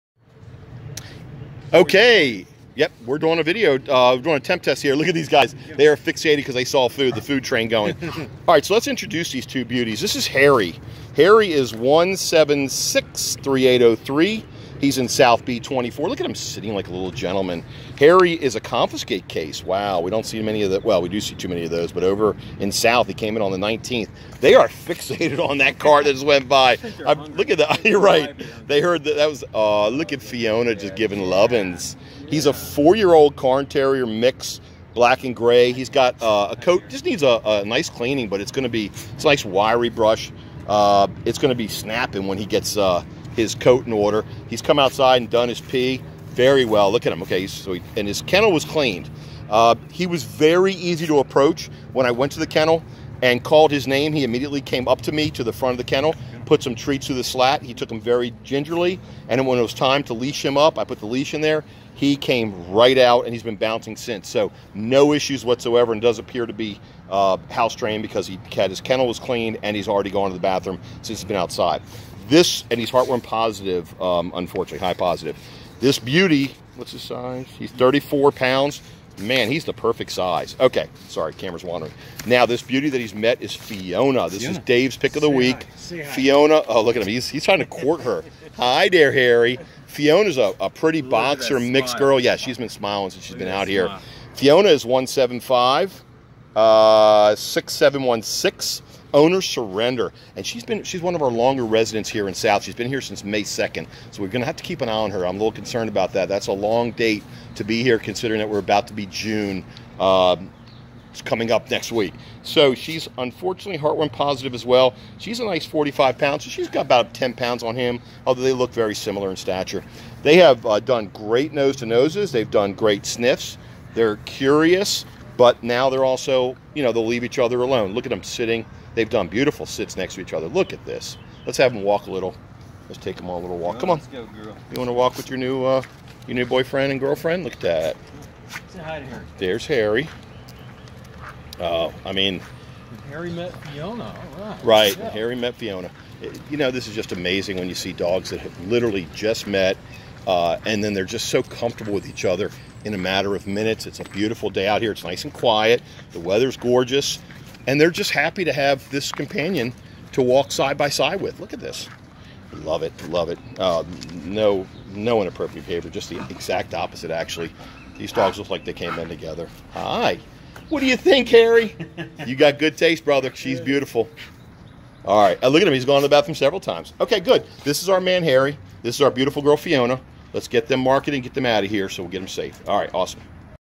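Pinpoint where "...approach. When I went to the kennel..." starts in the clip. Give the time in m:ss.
0:51.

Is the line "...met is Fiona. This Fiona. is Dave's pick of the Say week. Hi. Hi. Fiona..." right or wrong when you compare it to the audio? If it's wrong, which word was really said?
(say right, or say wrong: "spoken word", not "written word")
right.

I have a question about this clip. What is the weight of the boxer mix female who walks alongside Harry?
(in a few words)
45 pounds.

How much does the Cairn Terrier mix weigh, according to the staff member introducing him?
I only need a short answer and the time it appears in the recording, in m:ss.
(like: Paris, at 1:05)
34 pounds, at 1:17.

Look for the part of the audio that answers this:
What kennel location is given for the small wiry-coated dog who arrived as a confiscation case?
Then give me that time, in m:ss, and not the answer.
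0:15.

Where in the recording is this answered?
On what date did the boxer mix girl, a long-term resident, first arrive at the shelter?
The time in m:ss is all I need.
1:43.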